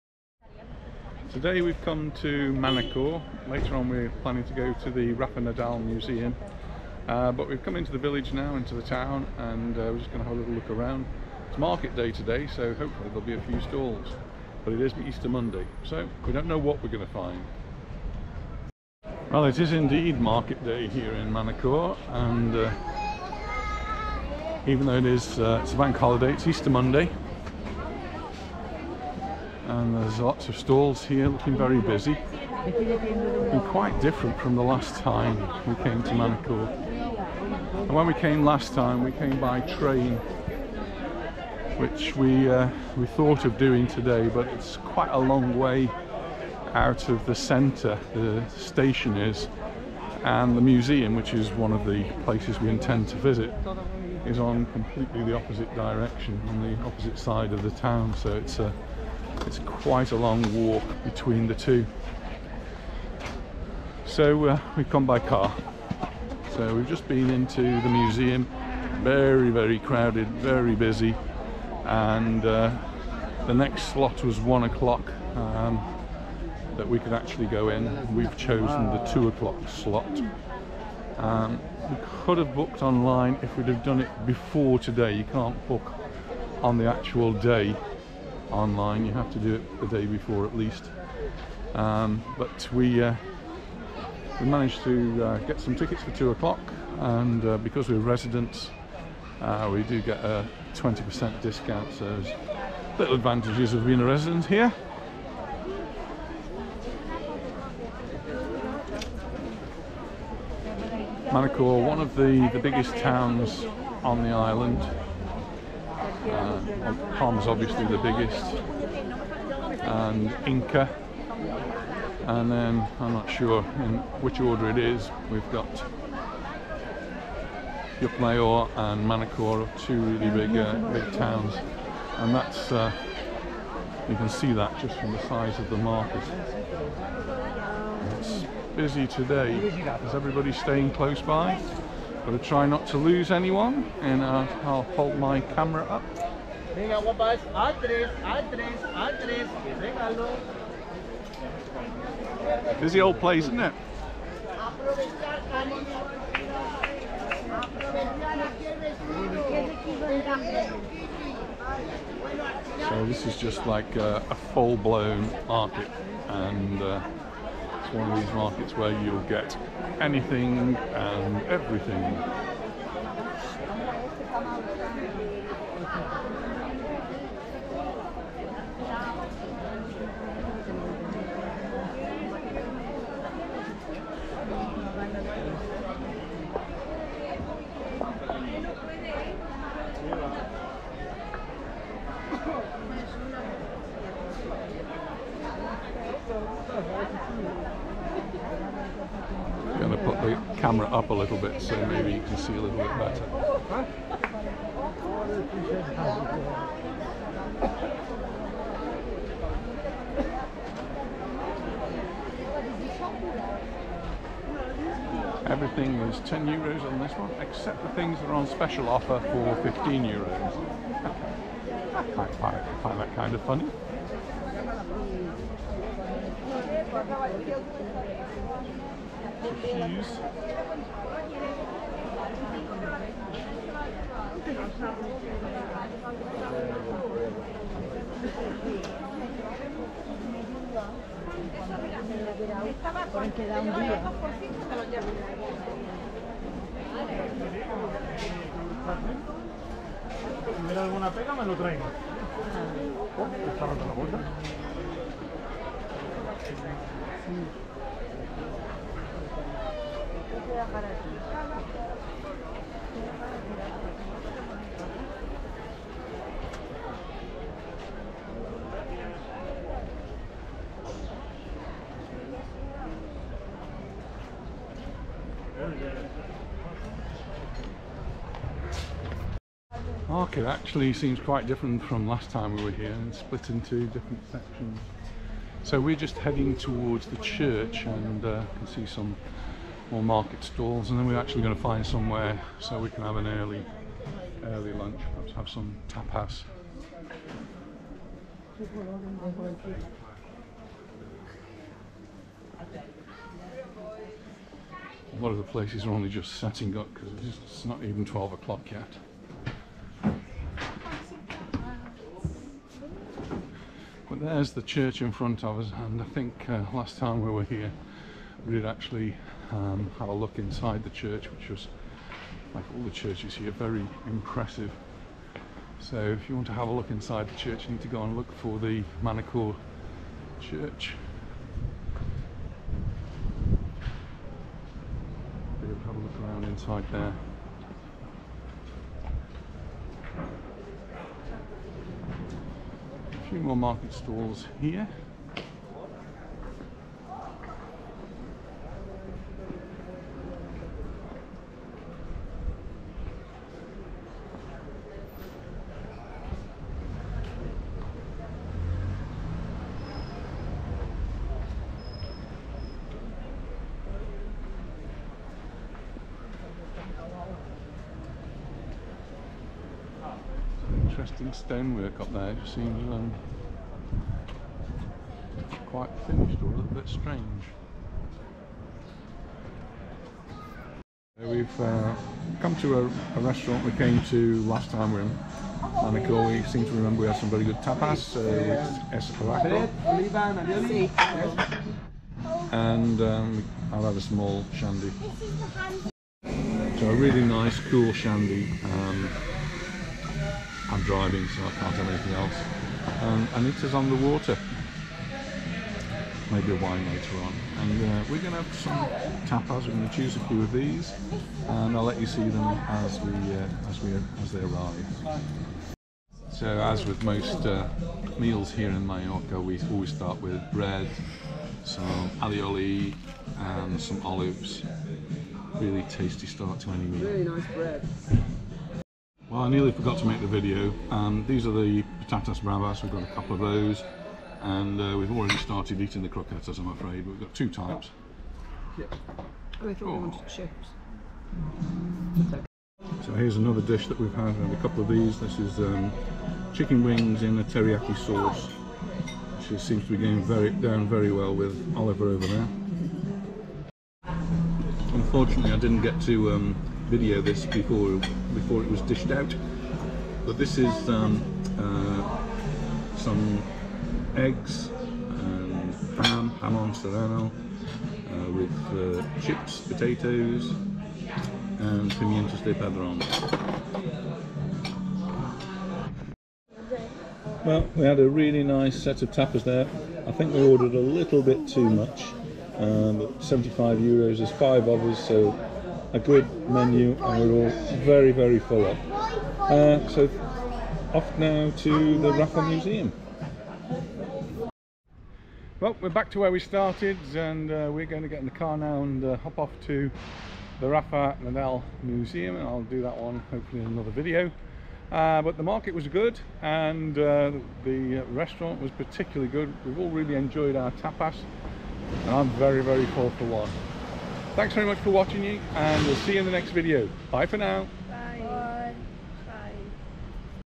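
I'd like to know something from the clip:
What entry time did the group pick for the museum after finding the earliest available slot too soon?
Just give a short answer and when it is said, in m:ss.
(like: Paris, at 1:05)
2 o'clock, at 1:18.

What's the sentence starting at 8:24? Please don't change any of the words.
Uh, but the market was good and uh, the uh, restaurant was particularly good.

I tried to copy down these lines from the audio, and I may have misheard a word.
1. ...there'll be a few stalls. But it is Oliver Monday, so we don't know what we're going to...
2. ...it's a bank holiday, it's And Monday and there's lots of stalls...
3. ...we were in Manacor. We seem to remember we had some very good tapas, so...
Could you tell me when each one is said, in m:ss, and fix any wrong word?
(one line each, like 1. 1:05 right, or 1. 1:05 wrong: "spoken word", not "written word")
1. 0:13 wrong: "Easter", not "Oliver"
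2. 0:25 wrong: "Easter", not "And"
3. 6:24 right.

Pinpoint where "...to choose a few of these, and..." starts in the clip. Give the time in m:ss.
6:49.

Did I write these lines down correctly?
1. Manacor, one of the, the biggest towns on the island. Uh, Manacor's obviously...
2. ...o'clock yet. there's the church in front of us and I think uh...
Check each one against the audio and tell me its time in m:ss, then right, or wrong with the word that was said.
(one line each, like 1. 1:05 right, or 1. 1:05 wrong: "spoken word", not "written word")
1. 1:51 wrong: "Palm", not "Manacor"
2. 5:08 right.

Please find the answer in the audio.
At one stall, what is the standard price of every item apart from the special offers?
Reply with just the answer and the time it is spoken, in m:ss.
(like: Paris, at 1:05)
10 euros, at 3:35.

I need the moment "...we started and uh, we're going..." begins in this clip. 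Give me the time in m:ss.
8:16.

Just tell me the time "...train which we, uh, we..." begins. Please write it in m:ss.
0:39.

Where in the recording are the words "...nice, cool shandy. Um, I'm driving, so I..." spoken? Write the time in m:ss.
6:37.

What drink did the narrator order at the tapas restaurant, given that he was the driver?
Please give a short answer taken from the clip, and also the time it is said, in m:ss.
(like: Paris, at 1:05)
small shandy, at 6:33.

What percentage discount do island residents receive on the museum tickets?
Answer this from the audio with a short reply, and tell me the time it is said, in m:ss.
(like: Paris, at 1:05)
20%, at 1:40.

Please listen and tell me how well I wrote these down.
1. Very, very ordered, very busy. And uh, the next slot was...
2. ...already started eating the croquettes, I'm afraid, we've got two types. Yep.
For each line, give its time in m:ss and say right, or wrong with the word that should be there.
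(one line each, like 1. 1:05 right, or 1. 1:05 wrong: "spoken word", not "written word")
1. 1:09 wrong: "crowded", not "ordered"
2. 7:15 right.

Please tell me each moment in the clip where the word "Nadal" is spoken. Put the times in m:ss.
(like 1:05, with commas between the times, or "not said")
0:05, 8:21.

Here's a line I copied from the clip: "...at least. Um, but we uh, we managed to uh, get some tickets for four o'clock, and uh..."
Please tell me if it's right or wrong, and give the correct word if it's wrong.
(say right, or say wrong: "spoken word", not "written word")
wrong: "two", not "four".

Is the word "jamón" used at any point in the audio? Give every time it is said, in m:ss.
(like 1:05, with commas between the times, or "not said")
7:46.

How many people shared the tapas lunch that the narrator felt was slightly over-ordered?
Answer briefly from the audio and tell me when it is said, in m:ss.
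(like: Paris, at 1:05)
5, at 8:04.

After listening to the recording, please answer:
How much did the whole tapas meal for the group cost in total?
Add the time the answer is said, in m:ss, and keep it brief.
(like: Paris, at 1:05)
75 euros, at 8:03.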